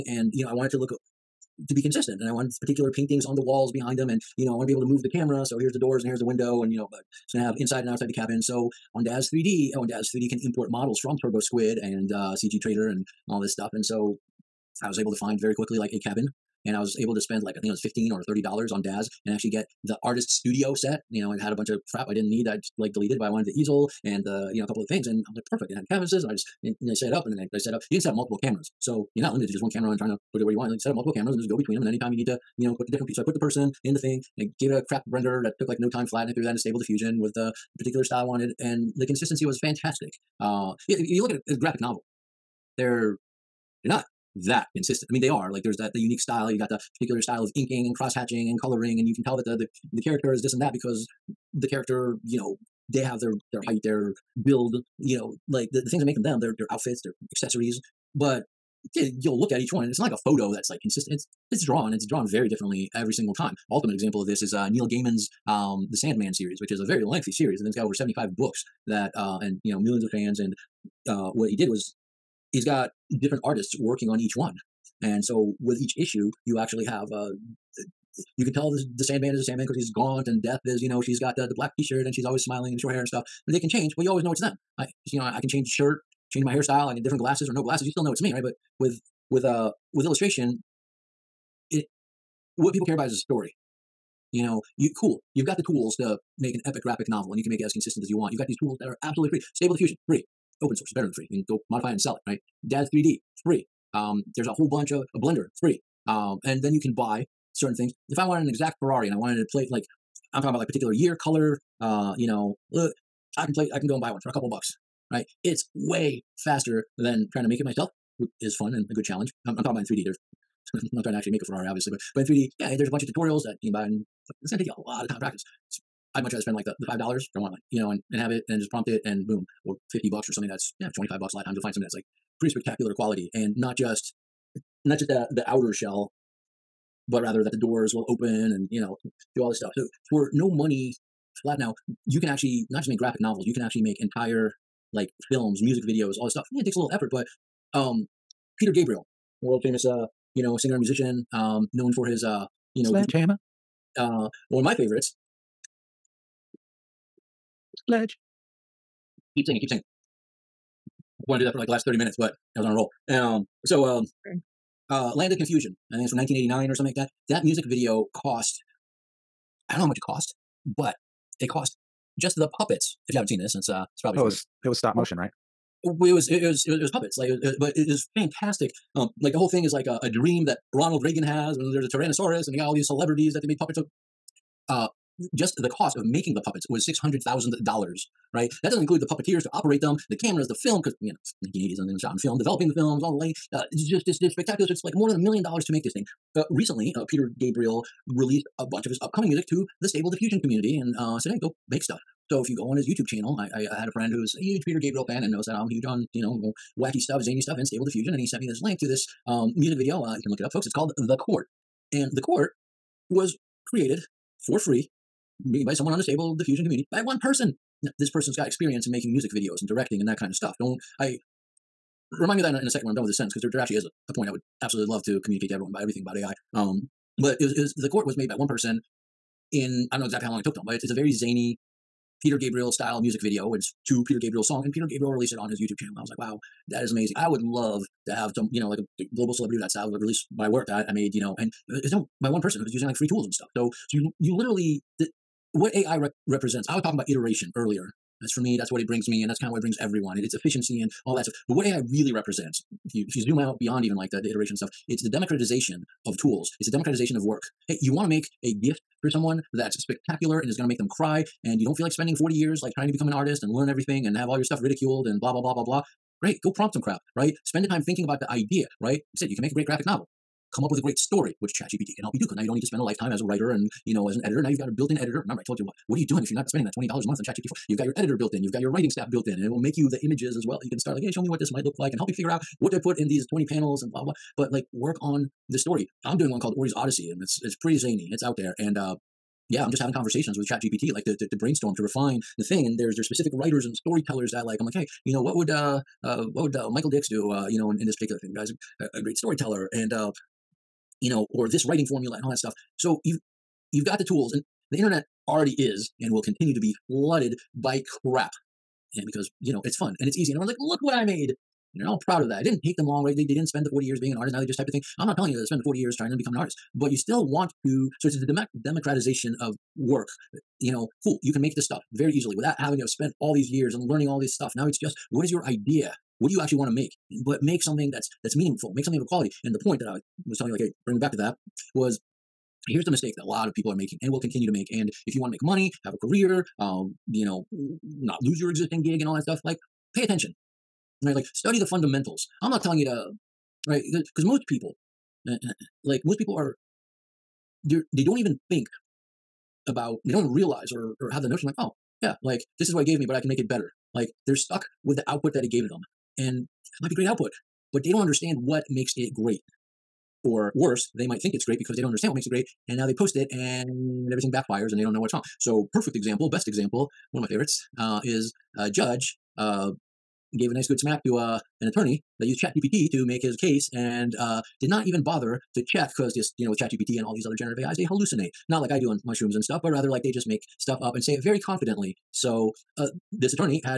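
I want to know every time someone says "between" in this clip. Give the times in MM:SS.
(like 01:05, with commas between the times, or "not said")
00:31.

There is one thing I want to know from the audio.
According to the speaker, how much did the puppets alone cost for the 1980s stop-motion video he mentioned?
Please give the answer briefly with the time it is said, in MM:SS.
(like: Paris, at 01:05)
$600,000, at 03:06.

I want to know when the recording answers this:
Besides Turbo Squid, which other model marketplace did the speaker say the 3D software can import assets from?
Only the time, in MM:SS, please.
00:12.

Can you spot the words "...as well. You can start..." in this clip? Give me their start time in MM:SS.
04:40.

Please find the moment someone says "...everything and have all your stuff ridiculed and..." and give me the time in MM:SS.
04:23.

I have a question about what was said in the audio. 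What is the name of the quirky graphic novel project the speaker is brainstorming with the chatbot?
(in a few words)
Ori's Odyssey.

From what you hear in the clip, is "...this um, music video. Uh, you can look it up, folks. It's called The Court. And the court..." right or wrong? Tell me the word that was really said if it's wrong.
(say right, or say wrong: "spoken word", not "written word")
right.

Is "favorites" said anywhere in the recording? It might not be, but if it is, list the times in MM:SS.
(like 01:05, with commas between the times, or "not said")
02:34, 06:07.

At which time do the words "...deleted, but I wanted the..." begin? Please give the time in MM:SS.
00:22.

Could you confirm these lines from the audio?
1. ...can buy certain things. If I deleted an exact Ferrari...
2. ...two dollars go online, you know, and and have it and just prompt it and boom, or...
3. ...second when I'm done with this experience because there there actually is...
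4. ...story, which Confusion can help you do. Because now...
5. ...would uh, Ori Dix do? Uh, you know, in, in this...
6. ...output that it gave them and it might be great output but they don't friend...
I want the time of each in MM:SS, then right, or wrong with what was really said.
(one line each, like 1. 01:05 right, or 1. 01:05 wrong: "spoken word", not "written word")
1. 01:46 wrong: "wanted", not "deleted"
2. 02:06 wrong: "five", not "two"
3. 03:42 wrong: "sentence", not "experience"
4. 04:30 wrong: "ChatGPT", not "Confusion"
5. 04:56 wrong: "Michael", not "Ori"
6. 05:55 wrong: "understand", not "friend".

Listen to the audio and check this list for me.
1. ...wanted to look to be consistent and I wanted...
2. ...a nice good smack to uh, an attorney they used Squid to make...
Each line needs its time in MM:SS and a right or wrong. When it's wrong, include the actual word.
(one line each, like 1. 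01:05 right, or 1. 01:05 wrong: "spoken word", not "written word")
1. 00:00 right
2. 06:10 wrong: "ChatGPT", not "Squid".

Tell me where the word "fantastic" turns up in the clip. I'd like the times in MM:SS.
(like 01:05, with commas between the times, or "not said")
00:39, 02:58.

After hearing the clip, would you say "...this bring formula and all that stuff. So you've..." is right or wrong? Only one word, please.
wrong.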